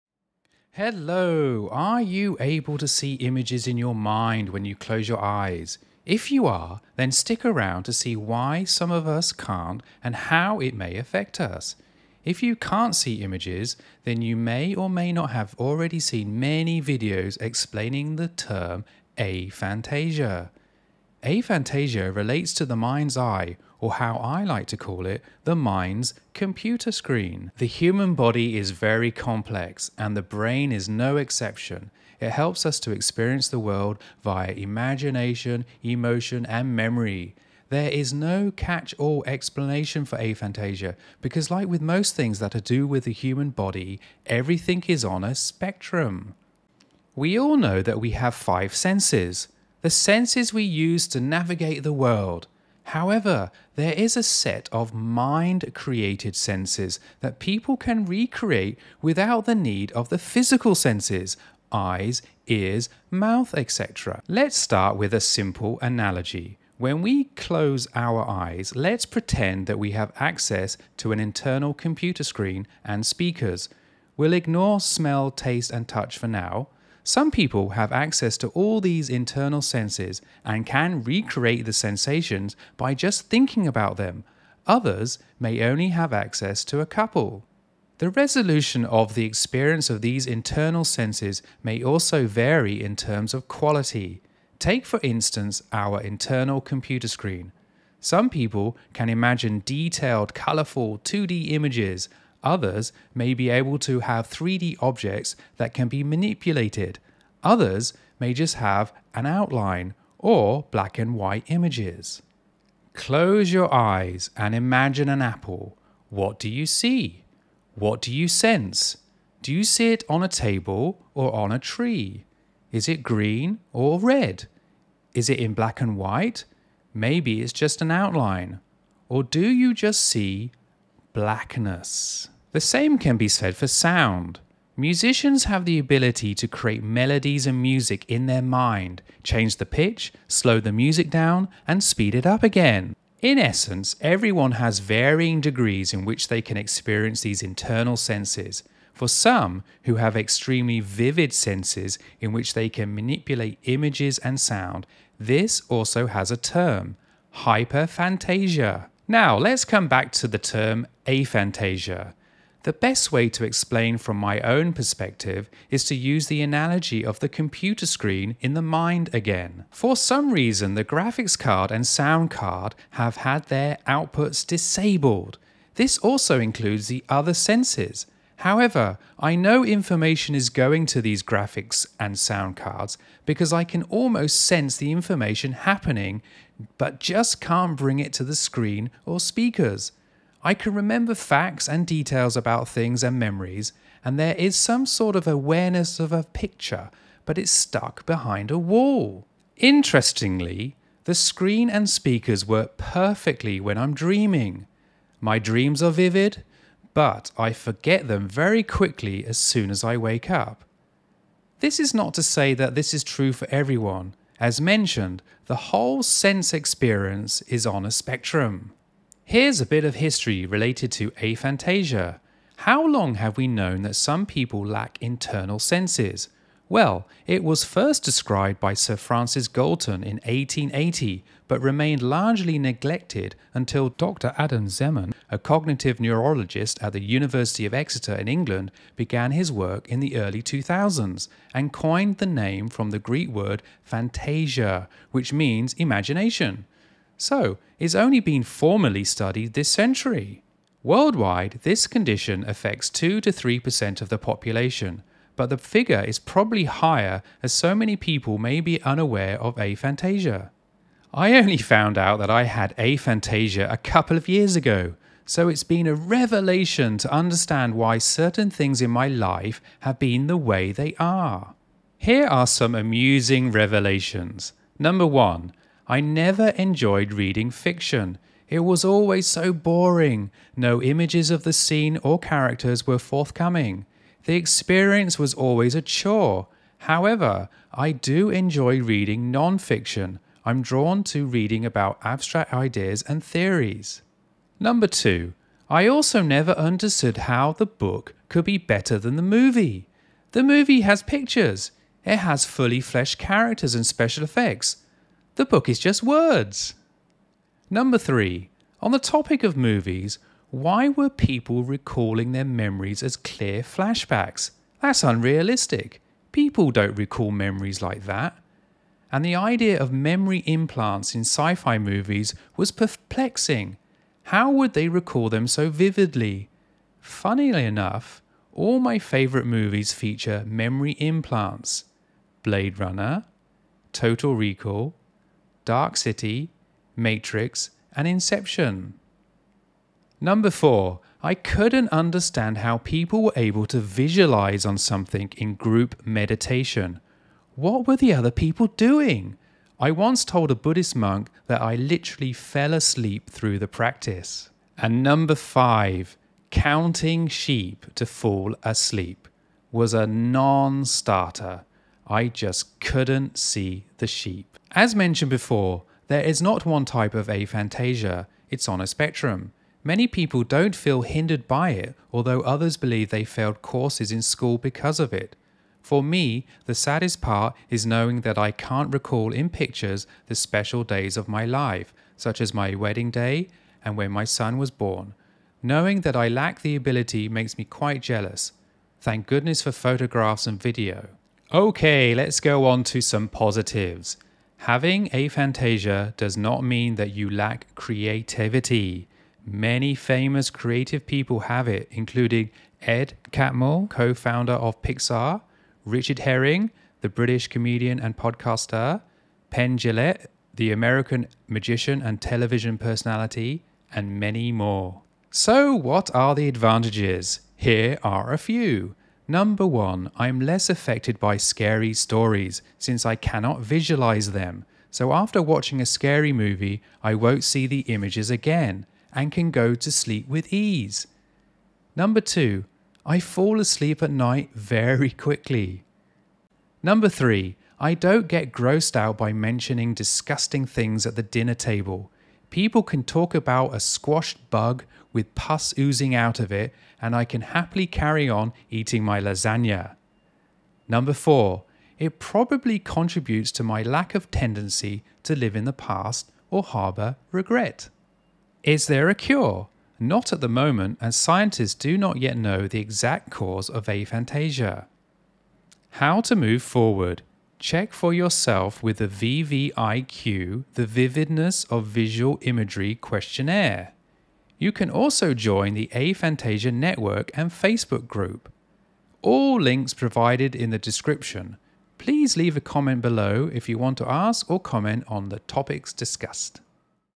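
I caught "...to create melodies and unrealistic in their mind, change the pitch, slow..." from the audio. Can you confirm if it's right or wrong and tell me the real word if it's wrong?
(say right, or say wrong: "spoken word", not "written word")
wrong: "music", not "unrealistic".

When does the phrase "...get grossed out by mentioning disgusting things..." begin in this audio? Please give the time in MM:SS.
07:18.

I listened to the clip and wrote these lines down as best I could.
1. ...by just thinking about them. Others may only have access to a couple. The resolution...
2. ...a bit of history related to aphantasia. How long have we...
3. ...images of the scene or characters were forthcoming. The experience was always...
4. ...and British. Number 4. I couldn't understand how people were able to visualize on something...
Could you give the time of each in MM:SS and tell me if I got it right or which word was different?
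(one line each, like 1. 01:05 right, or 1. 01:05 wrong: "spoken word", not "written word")
1. 01:22 right
2. 03:39 right
3. 04:40 right
4. 05:37 wrong: "Inception", not "British".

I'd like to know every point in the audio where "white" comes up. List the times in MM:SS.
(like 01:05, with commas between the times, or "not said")
01:51, 02:05.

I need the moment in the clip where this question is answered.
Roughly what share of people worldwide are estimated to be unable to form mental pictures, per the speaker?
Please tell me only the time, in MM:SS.
04:12.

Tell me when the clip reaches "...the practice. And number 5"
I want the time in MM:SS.
05:53.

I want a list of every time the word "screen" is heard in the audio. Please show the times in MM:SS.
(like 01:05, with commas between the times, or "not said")
00:26, 01:12, 01:37, 02:47, 03:08, 03:21.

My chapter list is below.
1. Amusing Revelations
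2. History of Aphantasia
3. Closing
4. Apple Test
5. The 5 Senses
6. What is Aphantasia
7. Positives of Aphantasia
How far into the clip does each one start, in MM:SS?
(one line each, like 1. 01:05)
1. 04:31
2. 03:39
3. 07:45
4. 01:53
5. 00:46
6. 02:40
7. 07:20.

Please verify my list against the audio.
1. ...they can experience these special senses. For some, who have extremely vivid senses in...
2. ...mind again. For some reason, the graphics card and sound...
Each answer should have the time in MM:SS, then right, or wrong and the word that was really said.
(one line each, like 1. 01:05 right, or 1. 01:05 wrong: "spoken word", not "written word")
1. 02:26 wrong: "internal", not "special"
2. 02:48 right.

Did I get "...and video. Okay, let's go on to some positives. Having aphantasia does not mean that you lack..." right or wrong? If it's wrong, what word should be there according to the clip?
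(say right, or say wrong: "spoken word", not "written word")
right.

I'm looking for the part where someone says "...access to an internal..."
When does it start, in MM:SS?
01:10.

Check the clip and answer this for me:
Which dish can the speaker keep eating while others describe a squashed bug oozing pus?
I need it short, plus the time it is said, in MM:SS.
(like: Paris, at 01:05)
lasagna, at 07:29.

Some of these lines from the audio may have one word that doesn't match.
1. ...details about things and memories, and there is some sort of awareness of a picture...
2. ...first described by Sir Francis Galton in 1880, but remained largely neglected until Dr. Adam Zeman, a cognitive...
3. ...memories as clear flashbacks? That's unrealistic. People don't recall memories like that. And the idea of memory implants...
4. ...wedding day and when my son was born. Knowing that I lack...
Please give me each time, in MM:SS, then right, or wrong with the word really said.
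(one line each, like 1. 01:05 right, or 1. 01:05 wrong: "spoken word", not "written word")
1. 03:11 right
2. 03:47 right
3. 05:12 right
4. 06:22 right.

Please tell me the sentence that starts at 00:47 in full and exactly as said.
We all know that we have five senses the senses we use to navigate the world.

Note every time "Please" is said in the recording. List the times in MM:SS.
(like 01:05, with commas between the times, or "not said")
08:01.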